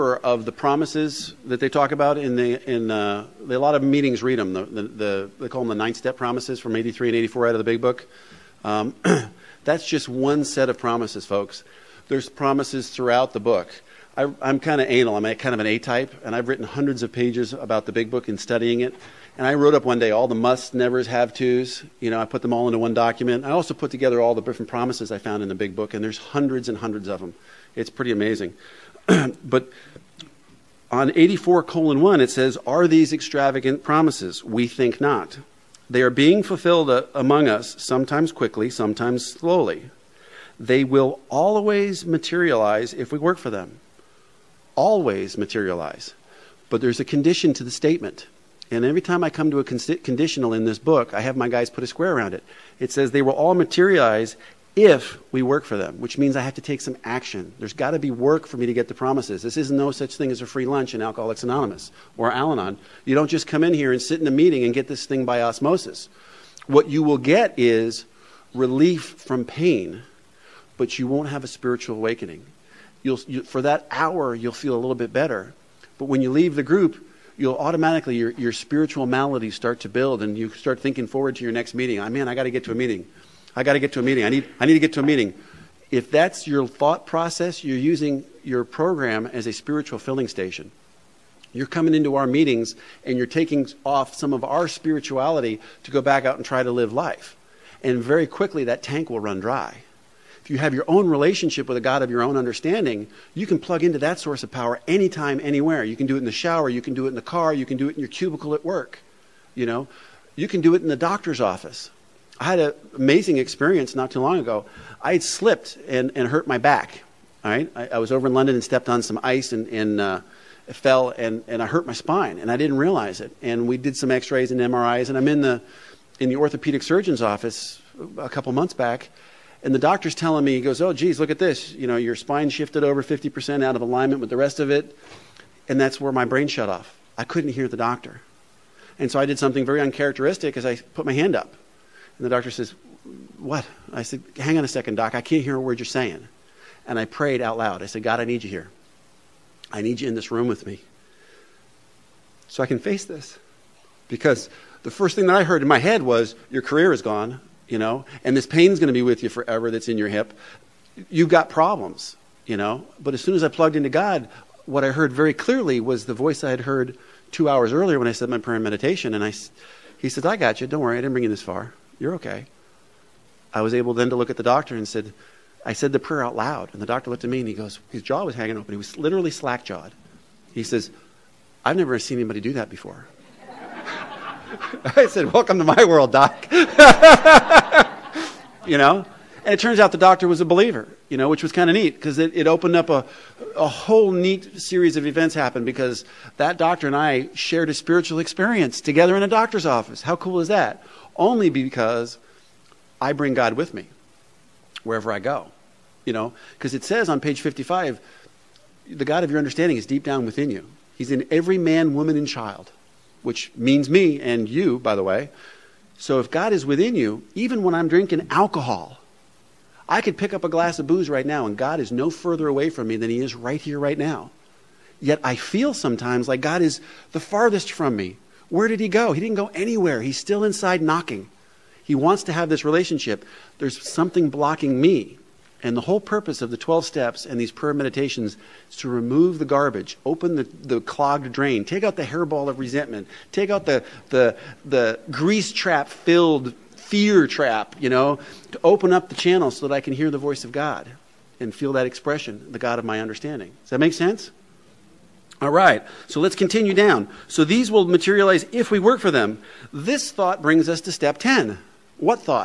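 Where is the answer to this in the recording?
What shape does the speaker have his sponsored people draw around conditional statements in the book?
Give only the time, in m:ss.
0:51.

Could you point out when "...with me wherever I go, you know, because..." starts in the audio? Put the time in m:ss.
3:23.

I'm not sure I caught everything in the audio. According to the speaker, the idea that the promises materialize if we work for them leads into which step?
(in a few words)
Step 10.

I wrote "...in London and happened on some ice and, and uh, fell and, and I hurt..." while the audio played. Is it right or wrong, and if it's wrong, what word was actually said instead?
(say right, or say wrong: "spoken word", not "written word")
wrong: "stepped", not "happened".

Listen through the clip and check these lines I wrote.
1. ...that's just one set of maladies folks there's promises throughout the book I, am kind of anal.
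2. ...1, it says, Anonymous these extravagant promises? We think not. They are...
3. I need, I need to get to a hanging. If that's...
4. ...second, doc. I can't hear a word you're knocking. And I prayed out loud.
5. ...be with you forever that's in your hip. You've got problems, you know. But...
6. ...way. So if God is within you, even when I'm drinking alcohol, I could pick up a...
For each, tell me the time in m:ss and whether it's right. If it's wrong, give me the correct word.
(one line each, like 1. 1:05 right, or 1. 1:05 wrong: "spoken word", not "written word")
1. 0:09 wrong: "promises", not "maladies"
2. 0:32 wrong: "Are", not "Anonymous"
3. 1:24 wrong: "meeting", not "hanging"
4. 2:24 wrong: "saying", not "knocking"
5. 2:38 right
6. 3:35 right.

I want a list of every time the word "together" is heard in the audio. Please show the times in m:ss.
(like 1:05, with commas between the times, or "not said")
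0:23, 3:18.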